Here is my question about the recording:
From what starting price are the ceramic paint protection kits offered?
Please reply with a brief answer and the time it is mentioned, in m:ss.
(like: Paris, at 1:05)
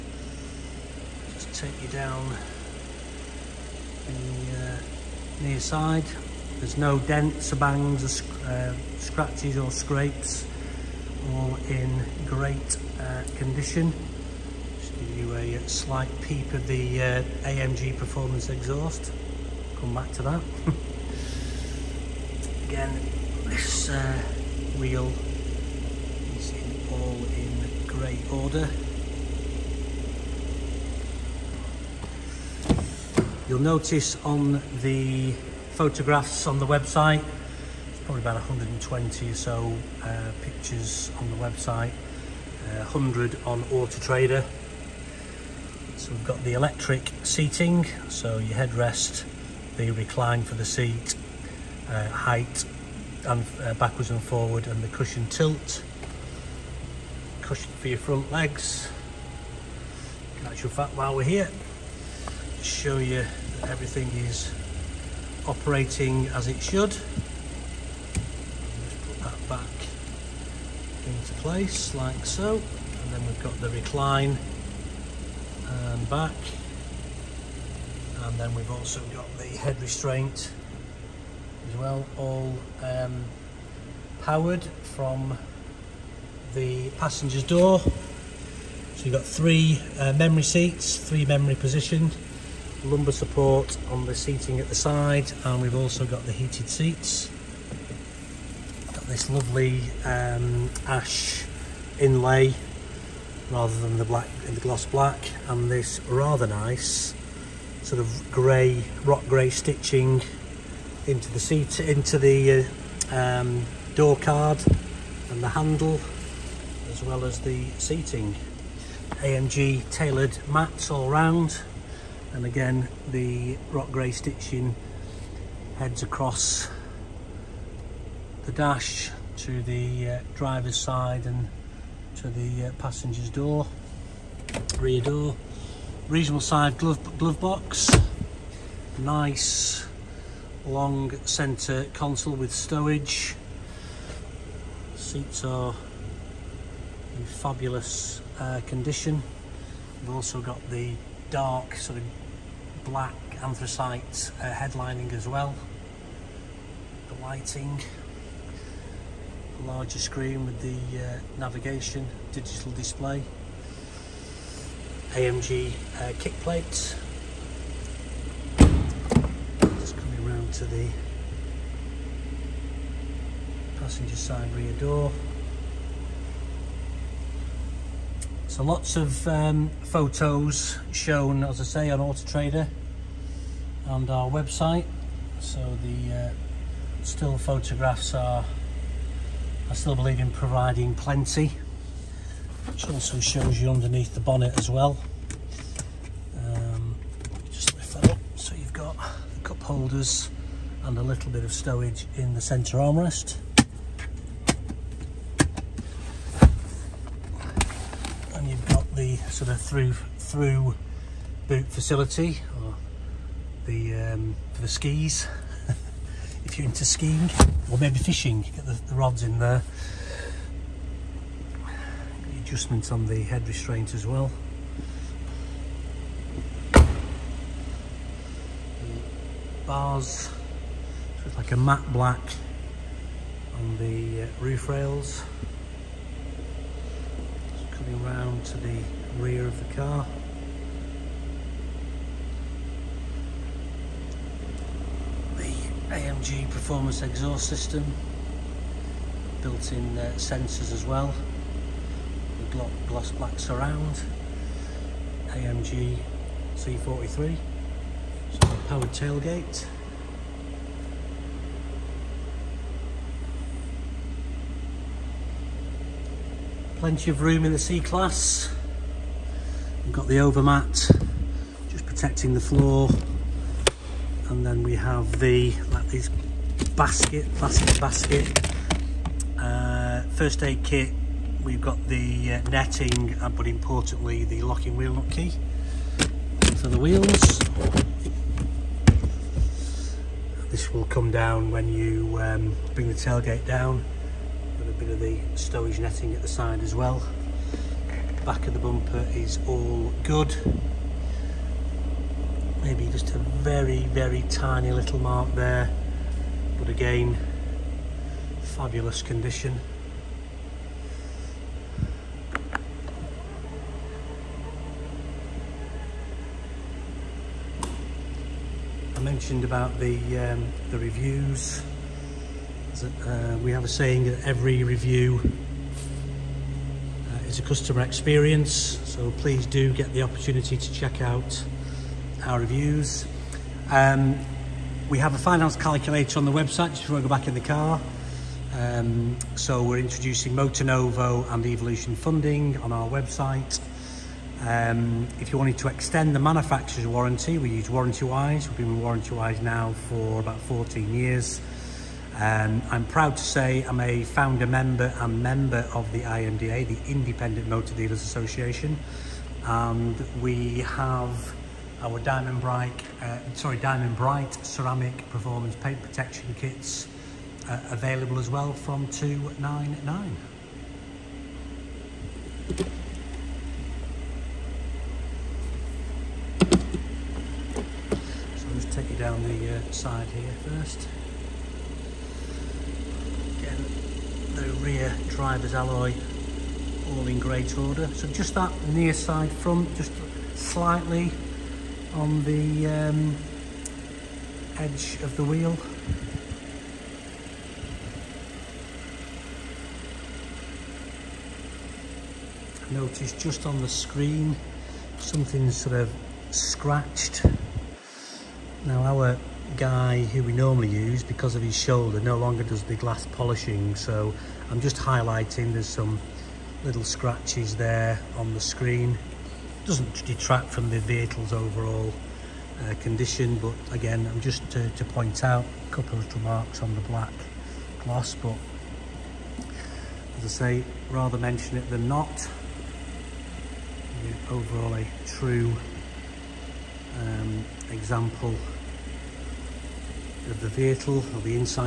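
299, at 6:08.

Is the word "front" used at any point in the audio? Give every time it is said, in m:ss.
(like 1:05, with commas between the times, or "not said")
0:57, 6:29.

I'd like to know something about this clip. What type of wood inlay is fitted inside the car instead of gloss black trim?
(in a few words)
ash.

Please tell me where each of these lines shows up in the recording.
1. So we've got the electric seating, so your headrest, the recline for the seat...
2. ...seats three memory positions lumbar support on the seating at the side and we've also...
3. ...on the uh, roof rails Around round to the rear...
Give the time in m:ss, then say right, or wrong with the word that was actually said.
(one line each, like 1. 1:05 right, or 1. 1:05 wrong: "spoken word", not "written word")
1. 0:45 right
2. 1:30 right
3. 3:53 right.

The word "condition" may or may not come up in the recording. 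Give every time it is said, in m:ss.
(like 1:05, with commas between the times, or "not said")
0:13, 2:28, 5:09, 7:02.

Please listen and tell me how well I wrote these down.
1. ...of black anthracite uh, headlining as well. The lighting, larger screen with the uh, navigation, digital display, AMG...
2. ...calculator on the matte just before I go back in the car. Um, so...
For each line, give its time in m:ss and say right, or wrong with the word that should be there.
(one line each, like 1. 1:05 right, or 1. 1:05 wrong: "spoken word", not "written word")
1. 2:31 right
2. 5:35 wrong: "website", not "matte".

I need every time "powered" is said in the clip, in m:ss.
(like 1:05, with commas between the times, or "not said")
1:24, 4:18.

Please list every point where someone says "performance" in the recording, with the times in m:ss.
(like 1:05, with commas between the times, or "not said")
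0:17, 4:06, 6:05.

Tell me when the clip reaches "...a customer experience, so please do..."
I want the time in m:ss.
5:27.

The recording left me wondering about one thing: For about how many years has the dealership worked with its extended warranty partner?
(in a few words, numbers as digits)
14.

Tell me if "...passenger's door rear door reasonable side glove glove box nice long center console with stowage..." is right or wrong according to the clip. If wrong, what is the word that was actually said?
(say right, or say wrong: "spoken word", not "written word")
right.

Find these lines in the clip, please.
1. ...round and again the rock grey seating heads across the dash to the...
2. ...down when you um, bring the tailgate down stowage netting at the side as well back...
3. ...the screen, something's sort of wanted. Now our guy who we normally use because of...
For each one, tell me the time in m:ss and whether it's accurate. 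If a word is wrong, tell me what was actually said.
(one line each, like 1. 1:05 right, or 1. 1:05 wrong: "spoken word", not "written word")
1. 2:01 wrong: "stitching", not "seating"
2. 4:51 right
3. 6:43 wrong: "scratched", not "wanted".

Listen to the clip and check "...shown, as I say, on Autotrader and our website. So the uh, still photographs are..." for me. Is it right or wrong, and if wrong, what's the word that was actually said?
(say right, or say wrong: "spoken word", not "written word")
right.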